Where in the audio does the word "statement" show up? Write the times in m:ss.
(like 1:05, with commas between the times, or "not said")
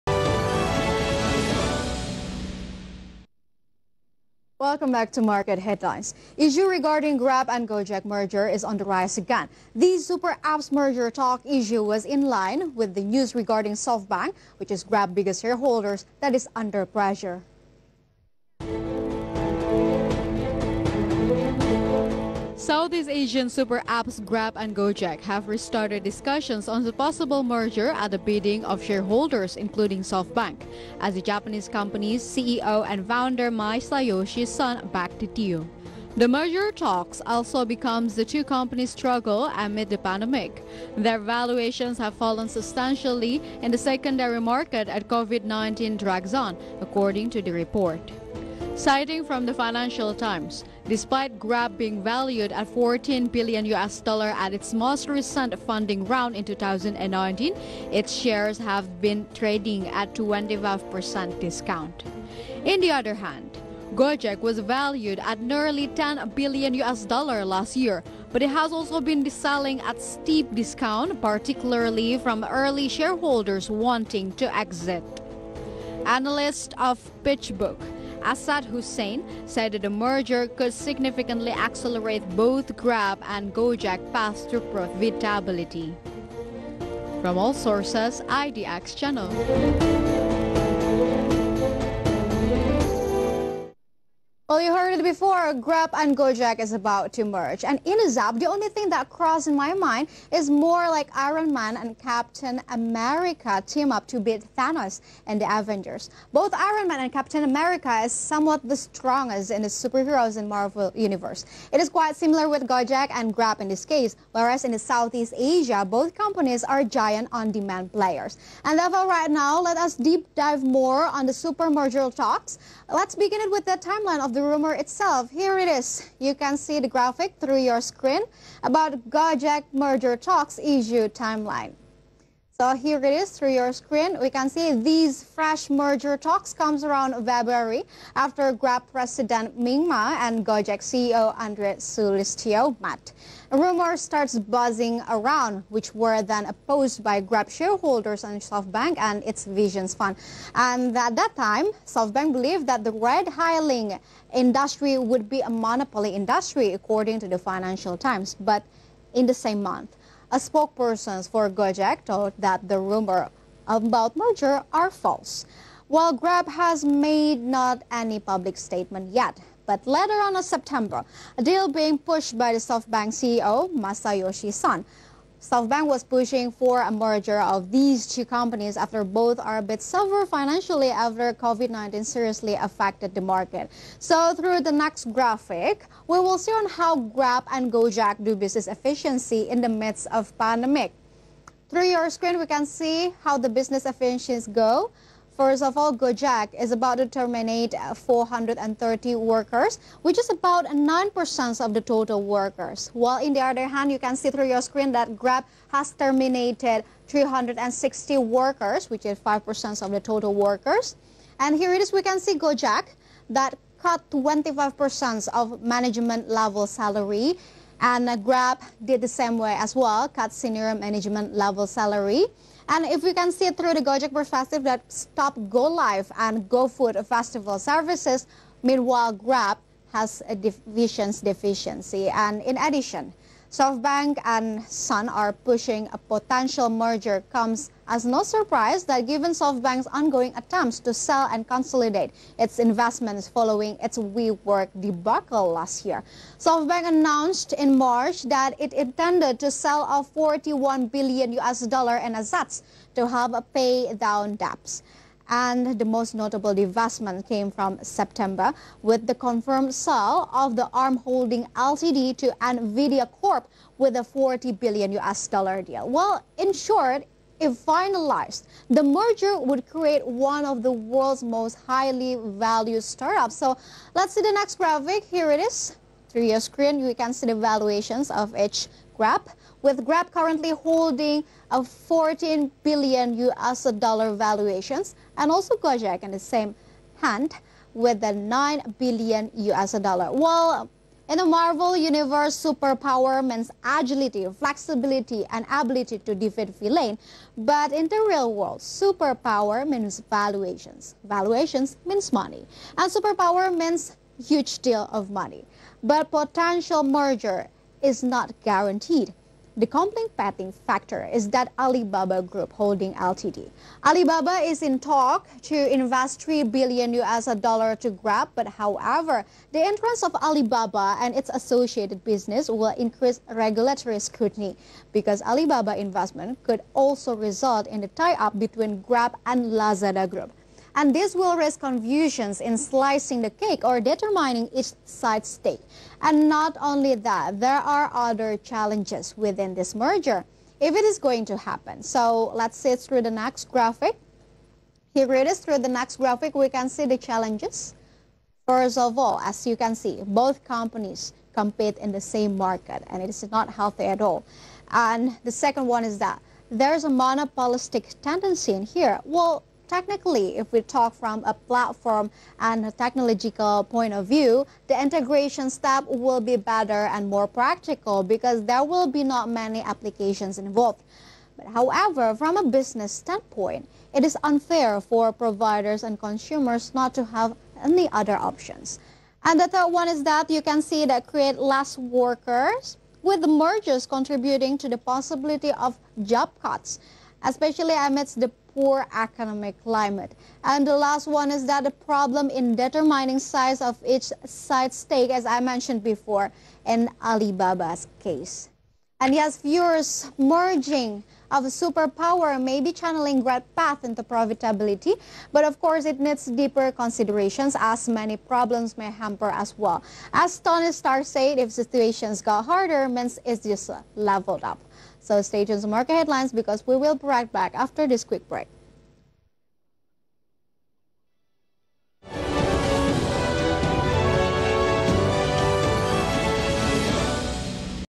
2:48.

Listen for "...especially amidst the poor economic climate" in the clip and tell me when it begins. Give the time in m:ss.
6:27.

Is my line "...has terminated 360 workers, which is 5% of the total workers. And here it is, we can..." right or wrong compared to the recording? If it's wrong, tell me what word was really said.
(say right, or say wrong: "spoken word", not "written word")
right.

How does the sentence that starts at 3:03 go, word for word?
So through the next graphic, we will see on how Grab and Gojek do business efficiency in the midst of pandemic.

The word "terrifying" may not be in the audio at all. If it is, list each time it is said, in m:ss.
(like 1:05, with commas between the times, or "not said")
not said.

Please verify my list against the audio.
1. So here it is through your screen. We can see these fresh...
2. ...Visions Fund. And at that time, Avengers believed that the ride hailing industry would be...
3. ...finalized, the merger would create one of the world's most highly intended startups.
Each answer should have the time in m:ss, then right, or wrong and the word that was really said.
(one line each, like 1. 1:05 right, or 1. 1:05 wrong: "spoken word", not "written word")
1. 2:12 right
2. 2:29 wrong: "SoftBank", not "Avengers"
3. 4:27 wrong: "valued", not "intended".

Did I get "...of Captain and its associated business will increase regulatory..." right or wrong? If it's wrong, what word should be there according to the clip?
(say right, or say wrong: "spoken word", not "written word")
wrong: "Alibaba", not "Captain".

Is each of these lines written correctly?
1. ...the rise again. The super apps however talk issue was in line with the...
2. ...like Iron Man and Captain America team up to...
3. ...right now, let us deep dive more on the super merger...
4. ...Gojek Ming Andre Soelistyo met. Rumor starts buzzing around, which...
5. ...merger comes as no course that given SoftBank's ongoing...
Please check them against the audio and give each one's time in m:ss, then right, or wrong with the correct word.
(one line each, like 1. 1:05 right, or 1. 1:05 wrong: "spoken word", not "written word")
1. 0:08 wrong: "merger", not "however"
2. 1:40 right
3. 1:59 right
4. 2:20 wrong: "CEO", not "Ming"
5. 3:56 wrong: "surprise", not "course".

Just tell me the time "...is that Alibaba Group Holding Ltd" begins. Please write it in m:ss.
5:11.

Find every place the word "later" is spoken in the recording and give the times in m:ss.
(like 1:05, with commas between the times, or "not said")
2:49.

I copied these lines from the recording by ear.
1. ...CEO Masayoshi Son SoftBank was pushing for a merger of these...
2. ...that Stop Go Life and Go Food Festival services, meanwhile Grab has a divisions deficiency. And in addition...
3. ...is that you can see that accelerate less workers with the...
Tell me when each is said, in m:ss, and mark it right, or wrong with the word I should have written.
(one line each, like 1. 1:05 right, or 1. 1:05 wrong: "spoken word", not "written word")
1. 2:53 right
2. 3:44 right
3. 6:19 wrong: "create", not "accelerate".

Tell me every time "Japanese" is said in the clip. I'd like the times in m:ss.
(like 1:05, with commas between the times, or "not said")
0:31.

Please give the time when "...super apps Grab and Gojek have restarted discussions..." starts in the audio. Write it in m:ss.
0:23.